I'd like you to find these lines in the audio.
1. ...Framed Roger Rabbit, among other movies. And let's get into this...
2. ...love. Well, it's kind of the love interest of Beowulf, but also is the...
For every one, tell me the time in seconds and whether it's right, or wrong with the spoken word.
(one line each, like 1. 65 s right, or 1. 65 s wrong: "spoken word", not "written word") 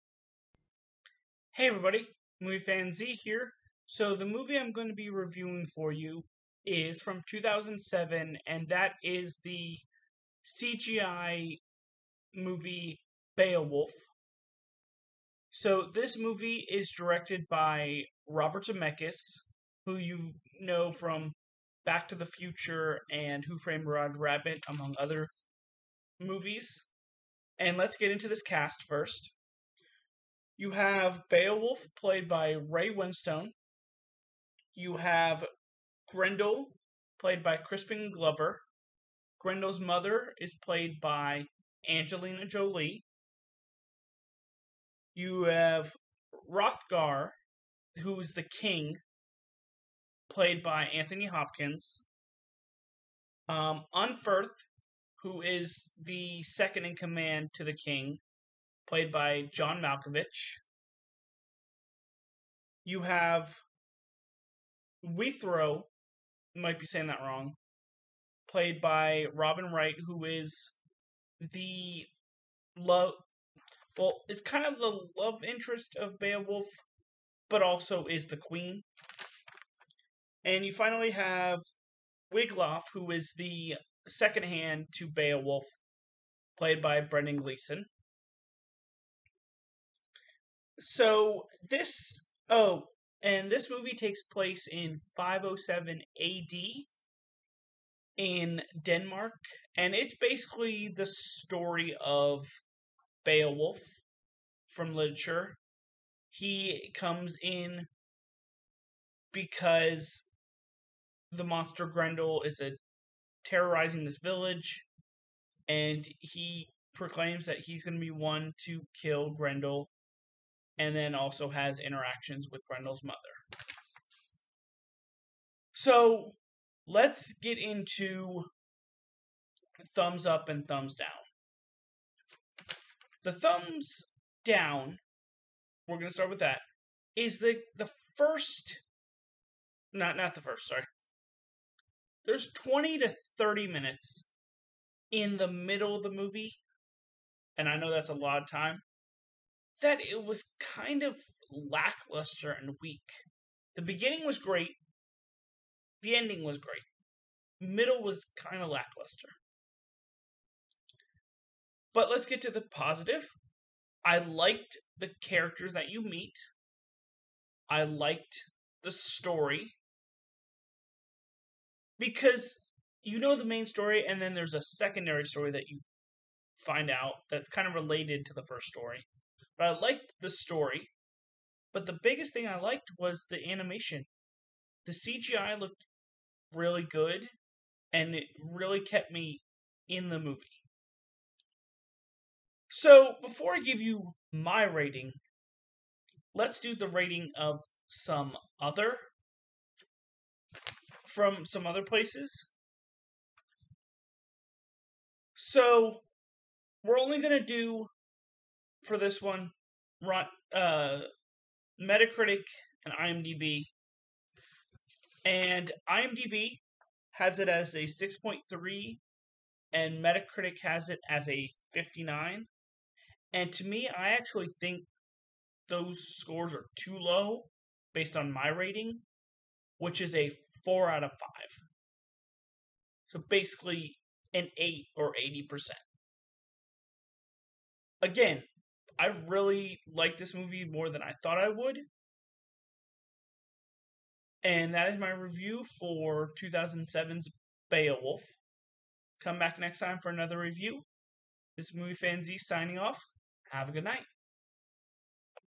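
1. 23 s right
2. 72 s right.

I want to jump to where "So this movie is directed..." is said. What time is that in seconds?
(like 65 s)
15 s.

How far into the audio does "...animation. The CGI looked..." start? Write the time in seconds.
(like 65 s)
183 s.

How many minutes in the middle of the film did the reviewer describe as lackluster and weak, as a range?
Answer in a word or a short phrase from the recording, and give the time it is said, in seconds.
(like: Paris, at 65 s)
20 to 30, at 142 s.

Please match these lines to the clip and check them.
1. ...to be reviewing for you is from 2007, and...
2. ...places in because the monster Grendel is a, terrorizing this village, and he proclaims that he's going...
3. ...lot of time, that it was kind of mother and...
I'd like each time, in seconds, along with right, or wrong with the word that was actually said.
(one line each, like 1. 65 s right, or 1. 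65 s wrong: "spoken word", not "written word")
1. 4 s right
2. 106 s wrong: "comes", not "places"
3. 148 s wrong: "lackluster", not "mother".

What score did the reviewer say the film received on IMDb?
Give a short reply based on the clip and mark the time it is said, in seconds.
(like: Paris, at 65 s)
6.3, at 217 s.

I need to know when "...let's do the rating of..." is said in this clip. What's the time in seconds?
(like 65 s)
196 s.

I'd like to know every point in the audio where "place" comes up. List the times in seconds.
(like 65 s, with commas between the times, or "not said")
94 s, 201 s.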